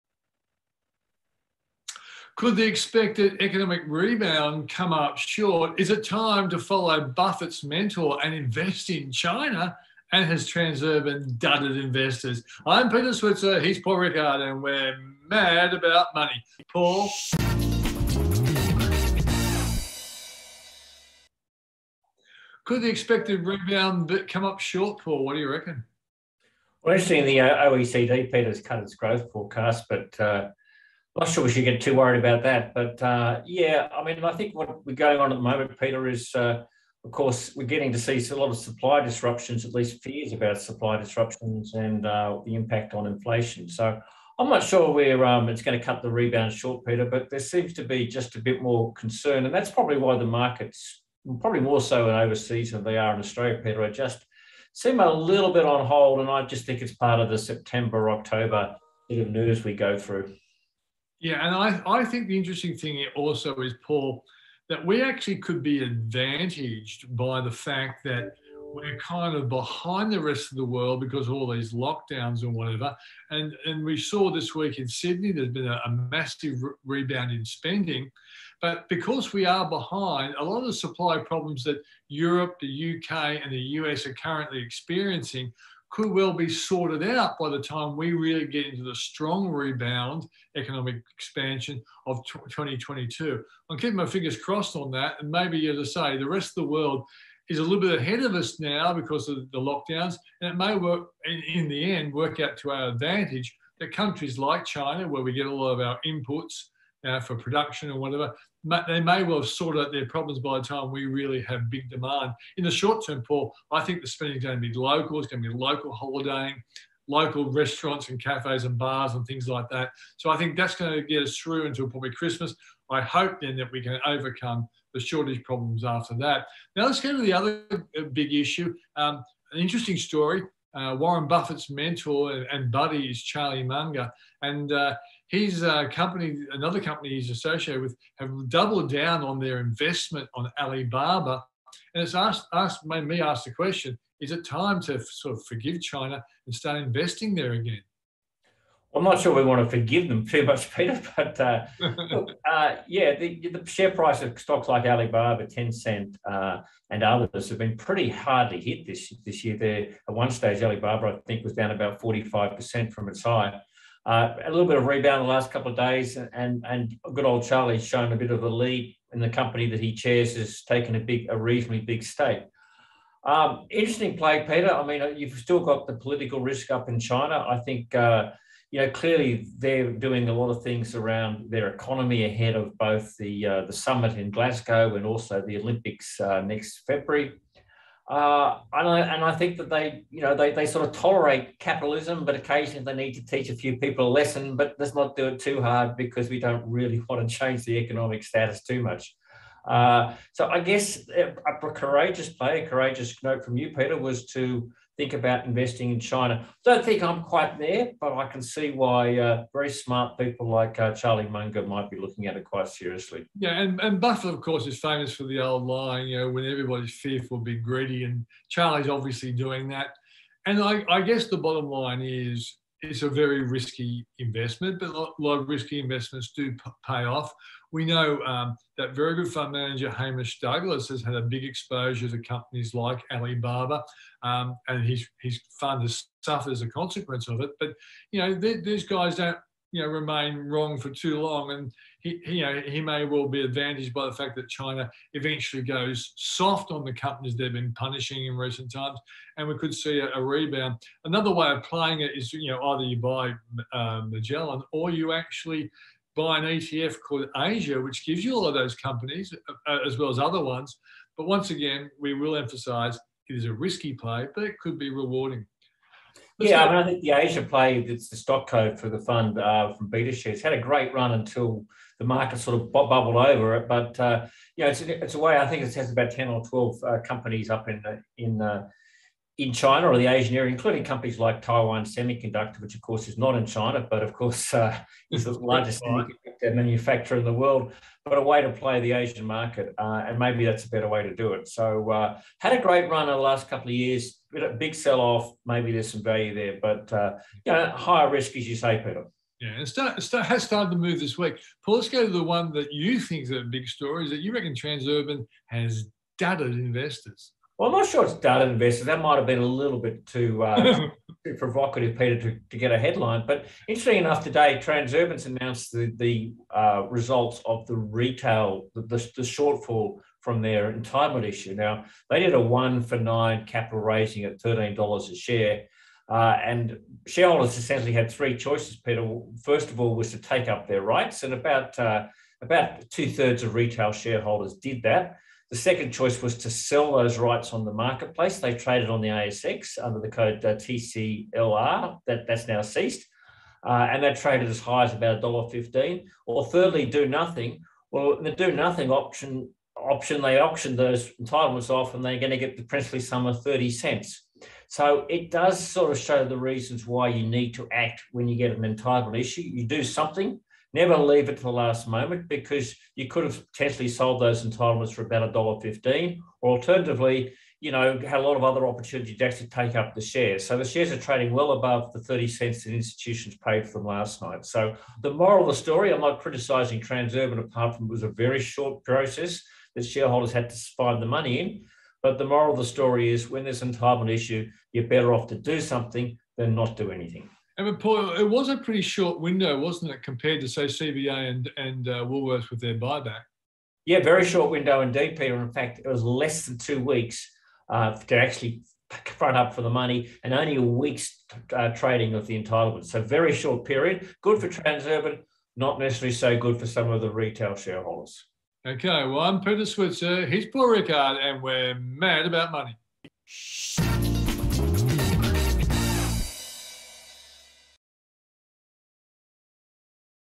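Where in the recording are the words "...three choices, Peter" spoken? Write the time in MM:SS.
05:28.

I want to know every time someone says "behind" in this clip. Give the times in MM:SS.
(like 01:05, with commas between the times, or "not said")
01:09, 01:19.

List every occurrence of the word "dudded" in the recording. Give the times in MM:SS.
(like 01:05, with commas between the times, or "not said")
00:11, 05:06.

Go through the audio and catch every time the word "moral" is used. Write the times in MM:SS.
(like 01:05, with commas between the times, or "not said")
06:15, 06:22.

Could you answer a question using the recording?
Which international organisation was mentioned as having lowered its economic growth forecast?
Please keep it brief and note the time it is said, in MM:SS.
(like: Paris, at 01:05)
OECD, at 00:27.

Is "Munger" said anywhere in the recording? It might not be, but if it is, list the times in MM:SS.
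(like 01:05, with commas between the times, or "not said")
02:13, 03:31.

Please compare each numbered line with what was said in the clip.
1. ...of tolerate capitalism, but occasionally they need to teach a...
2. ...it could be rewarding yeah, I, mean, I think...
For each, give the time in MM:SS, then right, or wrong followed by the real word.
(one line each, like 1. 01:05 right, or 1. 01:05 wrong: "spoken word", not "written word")
1. 03:10 right
2. 04:24 right.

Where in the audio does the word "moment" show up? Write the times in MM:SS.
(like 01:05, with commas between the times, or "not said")
00:35, 06:01.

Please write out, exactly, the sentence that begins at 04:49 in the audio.
Uh, and maybe that's a better way to do it.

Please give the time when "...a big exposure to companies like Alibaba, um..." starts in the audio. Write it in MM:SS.
03:51.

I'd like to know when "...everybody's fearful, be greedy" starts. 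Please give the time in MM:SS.
03:36.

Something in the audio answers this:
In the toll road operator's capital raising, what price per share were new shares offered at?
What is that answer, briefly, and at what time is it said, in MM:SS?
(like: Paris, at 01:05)
$13, at 05:24.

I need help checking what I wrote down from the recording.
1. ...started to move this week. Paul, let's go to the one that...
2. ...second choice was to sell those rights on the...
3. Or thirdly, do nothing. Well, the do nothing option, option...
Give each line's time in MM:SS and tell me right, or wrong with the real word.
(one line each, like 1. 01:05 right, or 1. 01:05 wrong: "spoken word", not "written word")
1. 05:00 right
2. 05:35 right
3. 05:46 right.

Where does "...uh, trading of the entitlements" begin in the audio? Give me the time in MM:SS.
06:41.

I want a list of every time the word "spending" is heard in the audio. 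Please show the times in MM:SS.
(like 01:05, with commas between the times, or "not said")
01:17, 01:54.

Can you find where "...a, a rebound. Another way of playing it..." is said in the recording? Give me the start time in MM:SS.
04:09.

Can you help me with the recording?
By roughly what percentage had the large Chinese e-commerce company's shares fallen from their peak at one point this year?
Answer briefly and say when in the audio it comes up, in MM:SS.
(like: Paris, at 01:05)
45%, at 02:42.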